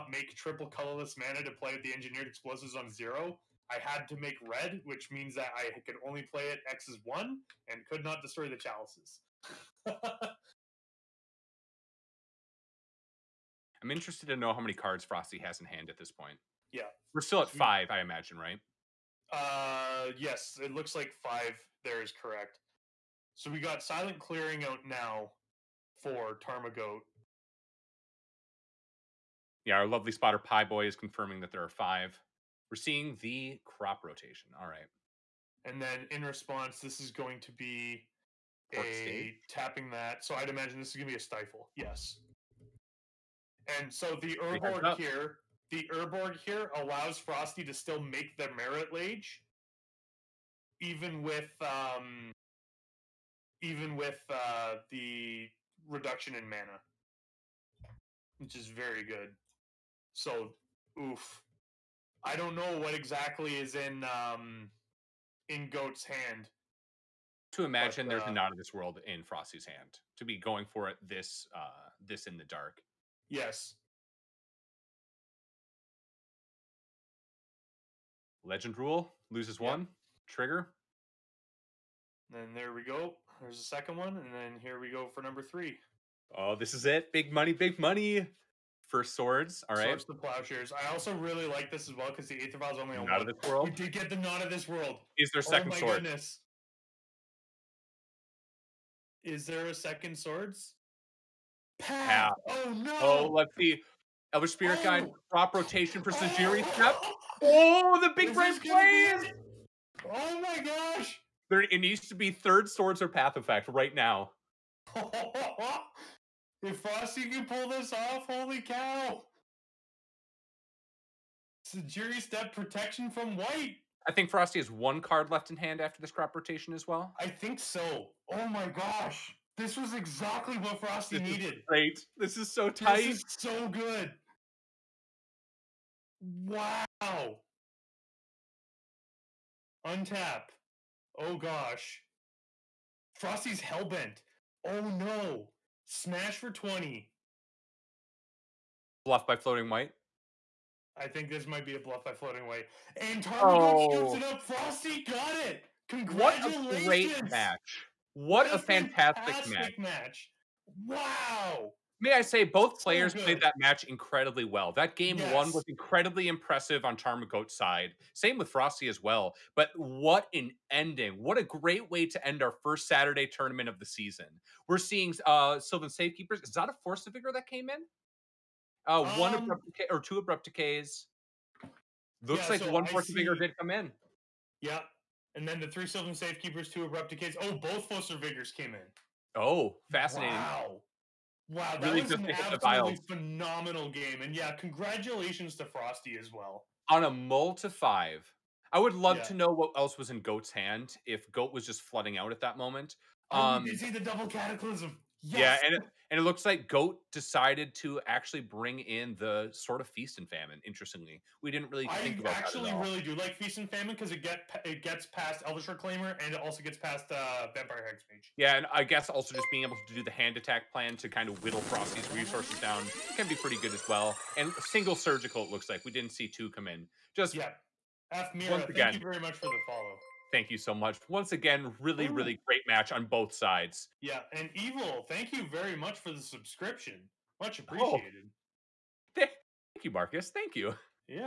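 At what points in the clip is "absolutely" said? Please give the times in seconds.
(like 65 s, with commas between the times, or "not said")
192 s.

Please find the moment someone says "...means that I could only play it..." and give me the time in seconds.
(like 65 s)
5 s.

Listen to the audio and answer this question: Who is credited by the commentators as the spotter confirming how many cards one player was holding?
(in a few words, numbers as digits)
Pie Boy.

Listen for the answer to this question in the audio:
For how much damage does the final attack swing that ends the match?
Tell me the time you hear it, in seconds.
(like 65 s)
146 s.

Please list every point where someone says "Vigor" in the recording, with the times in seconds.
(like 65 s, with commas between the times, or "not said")
177 s, 183 s, 188 s.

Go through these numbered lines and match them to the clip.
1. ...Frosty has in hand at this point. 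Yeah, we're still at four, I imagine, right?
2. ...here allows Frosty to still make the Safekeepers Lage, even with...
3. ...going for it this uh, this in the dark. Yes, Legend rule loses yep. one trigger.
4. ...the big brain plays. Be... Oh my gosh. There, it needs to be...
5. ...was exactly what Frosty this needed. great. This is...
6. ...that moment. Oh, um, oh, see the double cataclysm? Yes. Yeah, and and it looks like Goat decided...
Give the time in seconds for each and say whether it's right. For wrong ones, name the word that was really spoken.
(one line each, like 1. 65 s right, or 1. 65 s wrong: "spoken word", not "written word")
1. 15 s wrong: "five", not "four"
2. 46 s wrong: "Marit", not "Safekeepers"
3. 70 s right
4. 108 s right
5. 129 s right
6. 202 s right.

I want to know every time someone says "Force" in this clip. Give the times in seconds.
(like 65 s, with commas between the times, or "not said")
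176 s, 182 s, 187 s.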